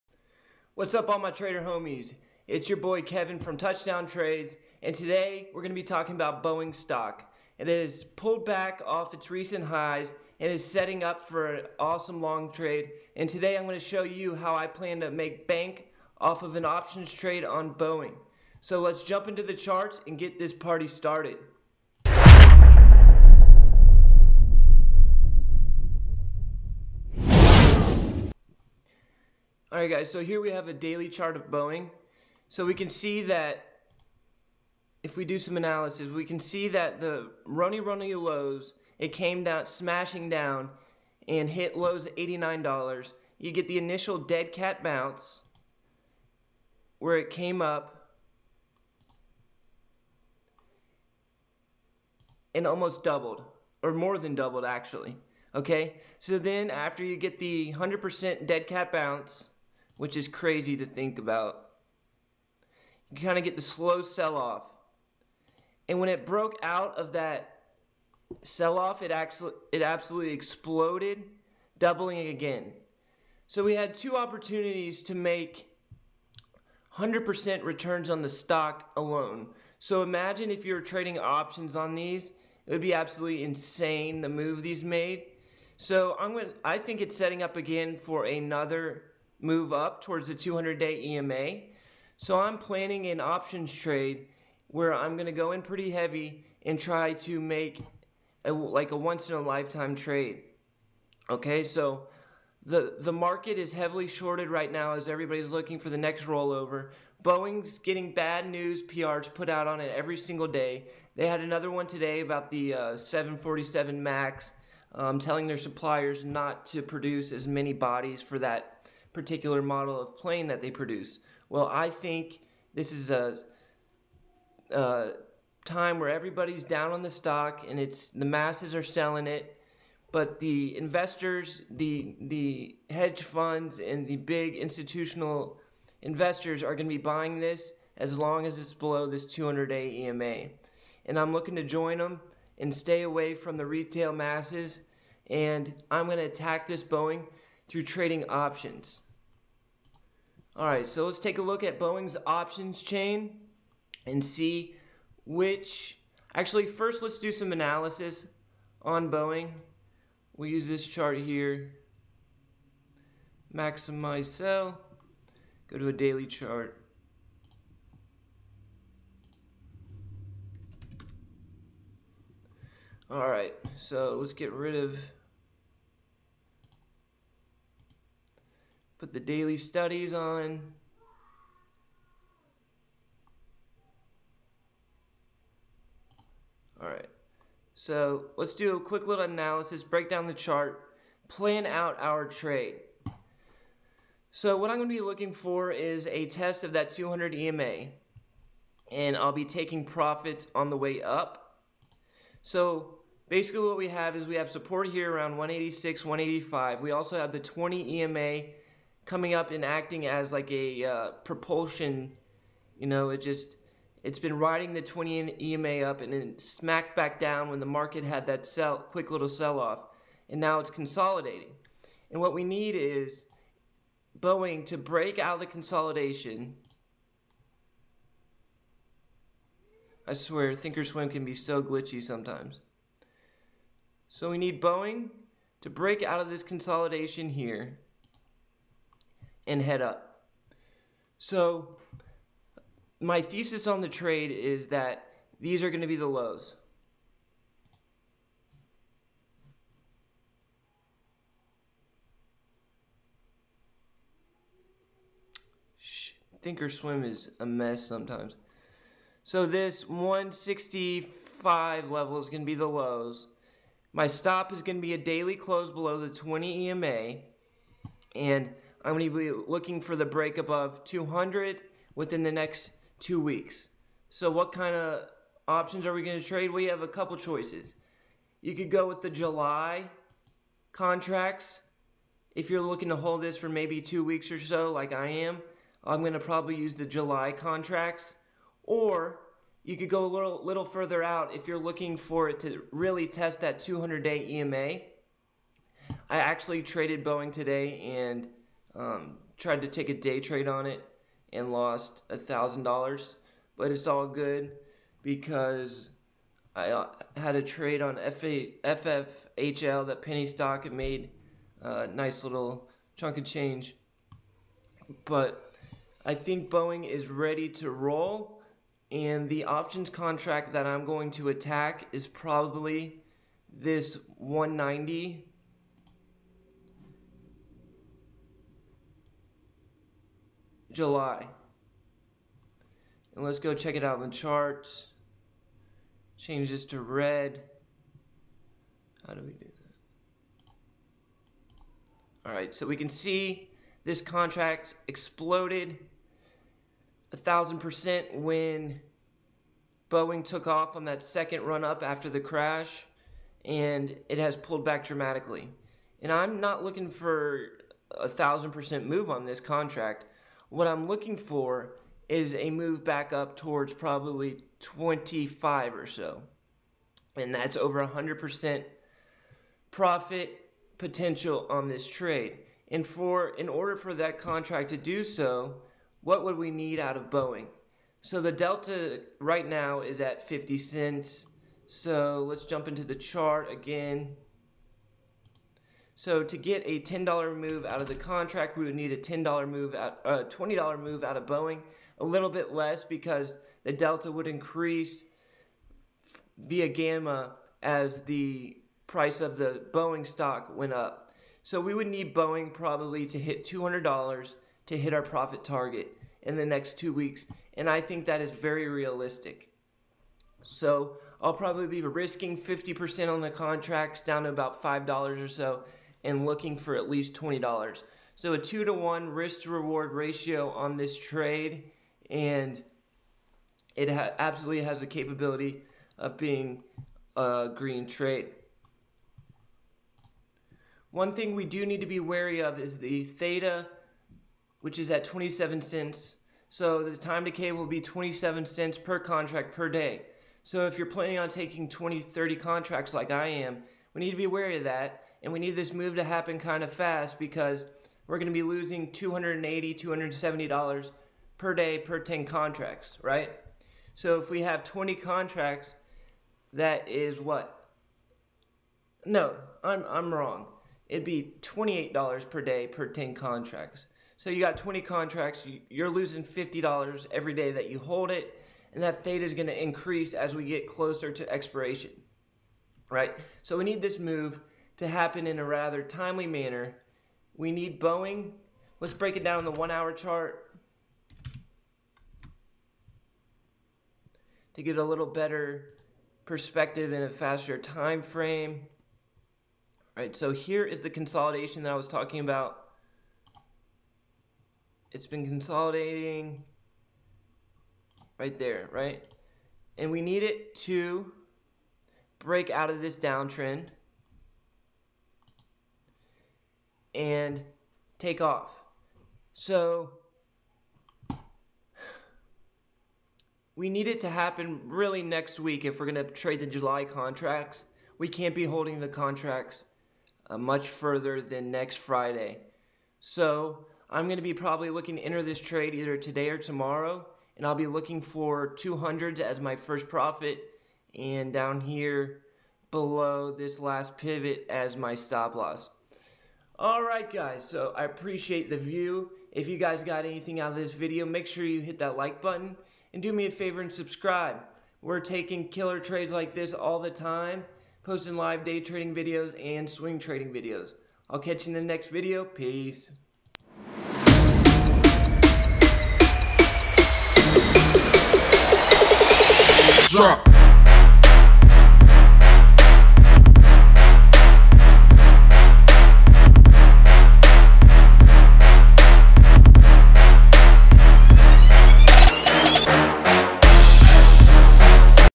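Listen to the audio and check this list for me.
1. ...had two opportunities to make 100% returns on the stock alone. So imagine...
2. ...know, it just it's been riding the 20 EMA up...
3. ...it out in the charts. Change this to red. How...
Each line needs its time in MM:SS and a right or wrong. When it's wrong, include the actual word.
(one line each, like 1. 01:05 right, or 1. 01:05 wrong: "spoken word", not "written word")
1. 01:13 right
2. 03:32 right
3. 05:33 right.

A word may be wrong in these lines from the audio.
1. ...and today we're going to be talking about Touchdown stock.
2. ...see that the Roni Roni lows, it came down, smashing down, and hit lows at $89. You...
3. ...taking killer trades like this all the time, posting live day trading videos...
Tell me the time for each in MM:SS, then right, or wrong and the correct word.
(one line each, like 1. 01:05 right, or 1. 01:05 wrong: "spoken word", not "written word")
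1. 00:04 wrong: "Boeing", not "Touchdown"
2. 00:36 right
3. 09:04 right.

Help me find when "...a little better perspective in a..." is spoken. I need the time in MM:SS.
08:04.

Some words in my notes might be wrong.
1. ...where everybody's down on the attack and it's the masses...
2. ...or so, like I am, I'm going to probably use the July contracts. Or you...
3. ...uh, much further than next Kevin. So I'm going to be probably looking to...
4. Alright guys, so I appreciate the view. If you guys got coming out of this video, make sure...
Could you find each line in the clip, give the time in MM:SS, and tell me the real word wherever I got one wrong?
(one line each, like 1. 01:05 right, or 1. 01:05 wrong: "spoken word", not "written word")
1. 02:05 wrong: "stock", not "attack"
2. 04:44 right
3. 08:40 wrong: "Friday", not "Kevin"
4. 08:56 wrong: "anything", not "coming".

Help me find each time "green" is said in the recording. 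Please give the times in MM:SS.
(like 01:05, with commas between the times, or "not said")
07:07.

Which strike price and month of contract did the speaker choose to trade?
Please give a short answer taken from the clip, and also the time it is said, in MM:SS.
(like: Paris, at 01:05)
190 July, at 05:24.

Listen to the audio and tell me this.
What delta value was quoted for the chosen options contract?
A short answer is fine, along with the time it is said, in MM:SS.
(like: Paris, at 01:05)
50 cents, at 06:20.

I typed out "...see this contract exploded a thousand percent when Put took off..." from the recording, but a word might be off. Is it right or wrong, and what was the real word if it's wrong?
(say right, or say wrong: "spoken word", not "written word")
wrong: "Boeing", not "Put".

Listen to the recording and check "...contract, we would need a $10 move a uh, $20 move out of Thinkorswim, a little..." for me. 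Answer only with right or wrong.
wrong.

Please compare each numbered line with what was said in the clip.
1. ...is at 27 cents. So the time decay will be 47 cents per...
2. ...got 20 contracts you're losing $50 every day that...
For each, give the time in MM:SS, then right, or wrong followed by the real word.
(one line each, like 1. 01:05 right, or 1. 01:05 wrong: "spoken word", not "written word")
1. 07:14 wrong: "27", not "47"
2. 07:44 right.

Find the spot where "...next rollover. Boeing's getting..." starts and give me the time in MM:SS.
01:45.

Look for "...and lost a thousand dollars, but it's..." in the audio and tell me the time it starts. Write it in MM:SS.
05:01.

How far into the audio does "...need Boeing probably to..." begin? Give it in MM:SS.
06:41.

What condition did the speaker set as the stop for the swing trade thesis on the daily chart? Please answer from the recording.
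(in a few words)
daily close below 20 EMA.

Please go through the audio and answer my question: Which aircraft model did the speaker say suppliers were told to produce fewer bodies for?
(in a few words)
747 Max.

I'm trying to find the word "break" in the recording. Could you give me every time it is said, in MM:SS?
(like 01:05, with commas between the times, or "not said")
03:09, 03:44, 03:55, 04:30, 07:58, 08:22.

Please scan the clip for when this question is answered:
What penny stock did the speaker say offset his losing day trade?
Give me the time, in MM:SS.
05:07.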